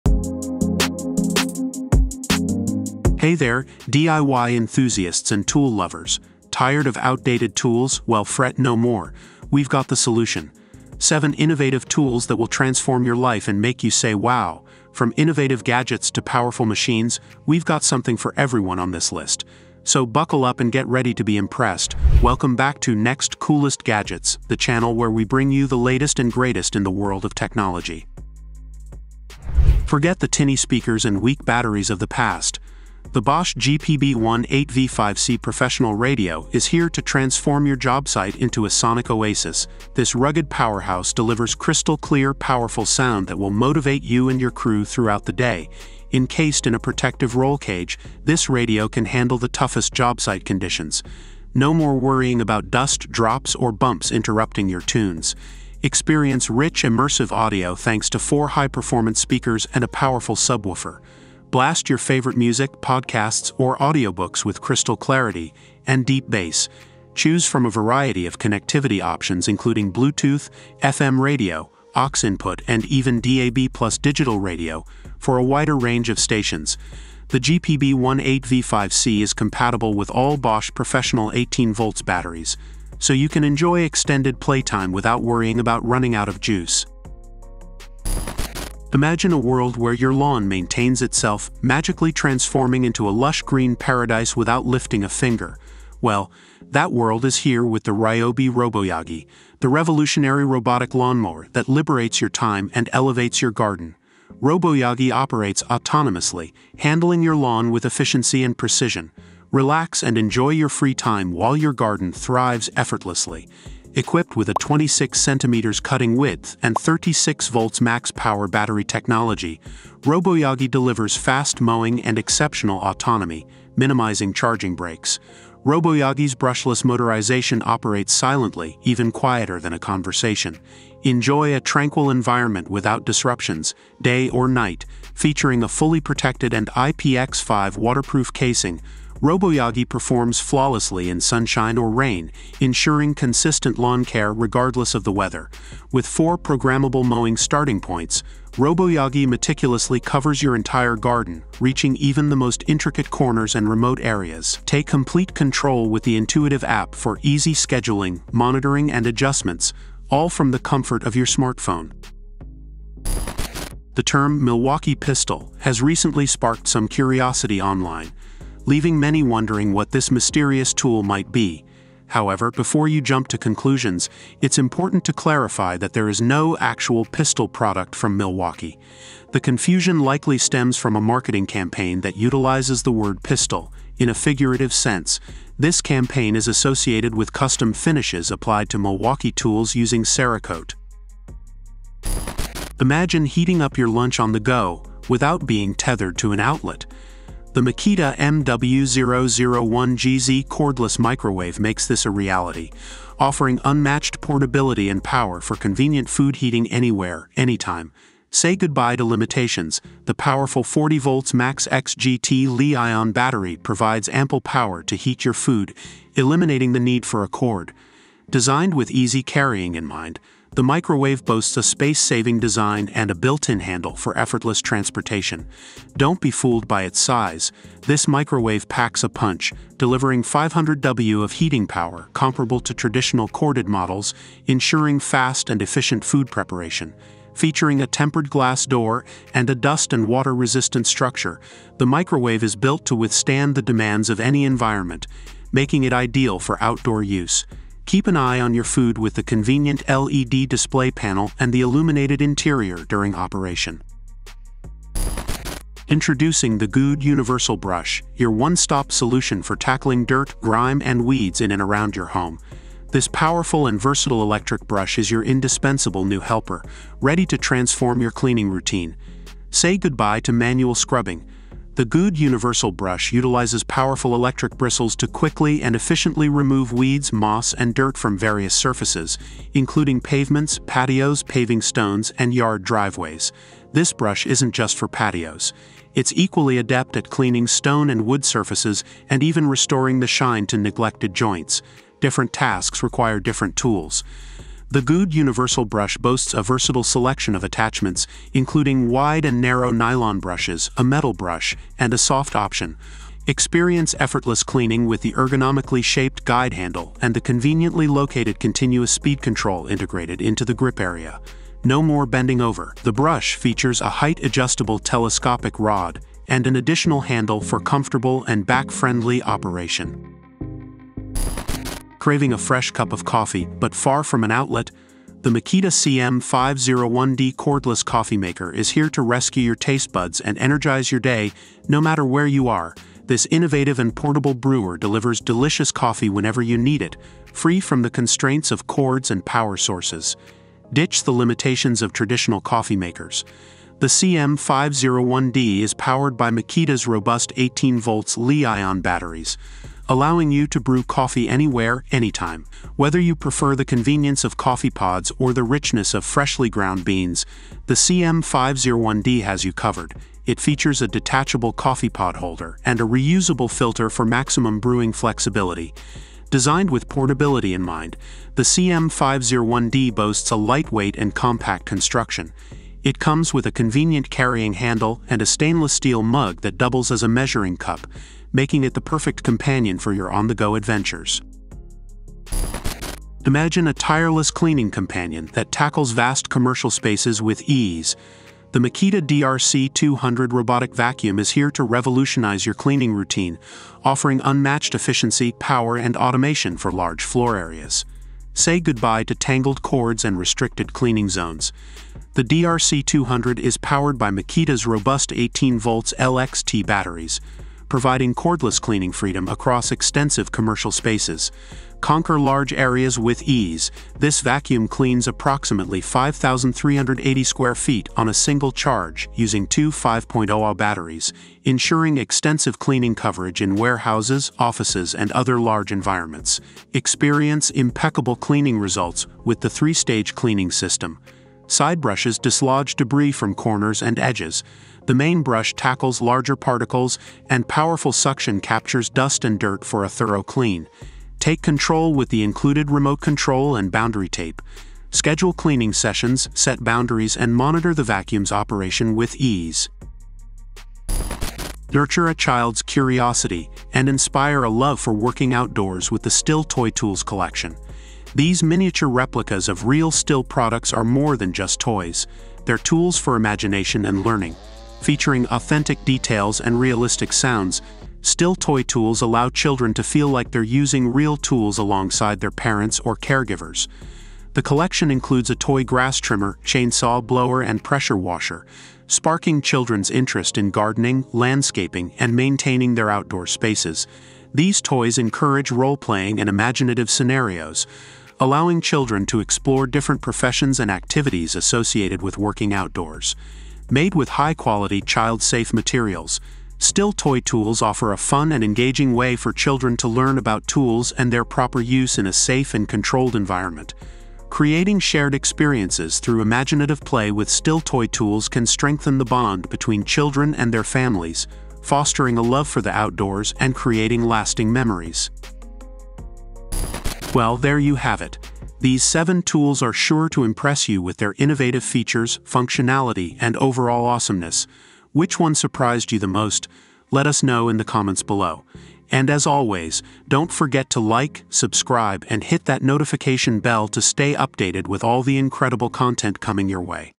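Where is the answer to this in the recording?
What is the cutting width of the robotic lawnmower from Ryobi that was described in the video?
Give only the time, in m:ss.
1:54.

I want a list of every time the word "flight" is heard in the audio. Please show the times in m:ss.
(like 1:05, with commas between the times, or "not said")
not said.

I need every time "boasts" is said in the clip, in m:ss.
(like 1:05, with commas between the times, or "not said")
3:41, 4:55, 6:09.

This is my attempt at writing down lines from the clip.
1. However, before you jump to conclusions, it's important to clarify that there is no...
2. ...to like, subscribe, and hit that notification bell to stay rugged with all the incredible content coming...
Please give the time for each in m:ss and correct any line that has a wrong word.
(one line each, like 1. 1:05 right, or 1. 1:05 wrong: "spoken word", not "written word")
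1. 2:52 right
2. 8:50 wrong: "updated", not "rugged".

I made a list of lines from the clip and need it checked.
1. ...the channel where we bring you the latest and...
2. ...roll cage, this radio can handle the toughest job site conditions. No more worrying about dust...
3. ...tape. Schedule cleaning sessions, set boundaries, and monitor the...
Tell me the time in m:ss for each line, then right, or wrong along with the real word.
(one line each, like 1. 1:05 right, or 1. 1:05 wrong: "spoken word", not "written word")
1. 0:24 right
2. 0:47 right
3. 7:24 right.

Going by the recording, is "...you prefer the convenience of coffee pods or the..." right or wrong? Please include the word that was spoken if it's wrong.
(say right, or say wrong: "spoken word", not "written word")
right.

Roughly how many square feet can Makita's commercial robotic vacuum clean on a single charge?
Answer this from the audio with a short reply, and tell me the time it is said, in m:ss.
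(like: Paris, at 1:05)
5,380, at 6:55.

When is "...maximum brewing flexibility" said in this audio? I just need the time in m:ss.
6:04.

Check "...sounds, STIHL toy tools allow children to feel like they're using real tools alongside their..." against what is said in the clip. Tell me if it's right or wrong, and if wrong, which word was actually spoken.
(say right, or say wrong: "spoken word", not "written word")
right.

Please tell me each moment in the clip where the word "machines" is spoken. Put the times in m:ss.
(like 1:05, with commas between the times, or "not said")
0:16.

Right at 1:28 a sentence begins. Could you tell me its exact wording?
Imagine a world where your lawn maintains itself, magically transforming into a lush green paradise without lifting a finger.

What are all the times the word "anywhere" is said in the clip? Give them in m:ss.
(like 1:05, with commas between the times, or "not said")
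3:26, 5:51.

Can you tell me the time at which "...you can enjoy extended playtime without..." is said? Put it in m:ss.
1:23.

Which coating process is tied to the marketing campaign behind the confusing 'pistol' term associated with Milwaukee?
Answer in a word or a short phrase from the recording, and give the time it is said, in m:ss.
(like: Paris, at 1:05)
Cerakote, at 3:10.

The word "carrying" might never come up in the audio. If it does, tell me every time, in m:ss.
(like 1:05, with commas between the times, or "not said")
3:39, 6:14.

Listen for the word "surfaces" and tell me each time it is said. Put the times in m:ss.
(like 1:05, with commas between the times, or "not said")
4:38, 4:48.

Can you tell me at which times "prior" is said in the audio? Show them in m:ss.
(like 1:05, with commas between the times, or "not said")
not said.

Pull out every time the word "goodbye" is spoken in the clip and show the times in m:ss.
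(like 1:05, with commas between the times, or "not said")
3:28, 4:29, 6:38.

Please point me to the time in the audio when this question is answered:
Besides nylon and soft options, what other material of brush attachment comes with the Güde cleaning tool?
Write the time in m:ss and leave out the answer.
5:00.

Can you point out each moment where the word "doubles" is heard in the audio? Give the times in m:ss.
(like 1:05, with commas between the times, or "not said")
6:16.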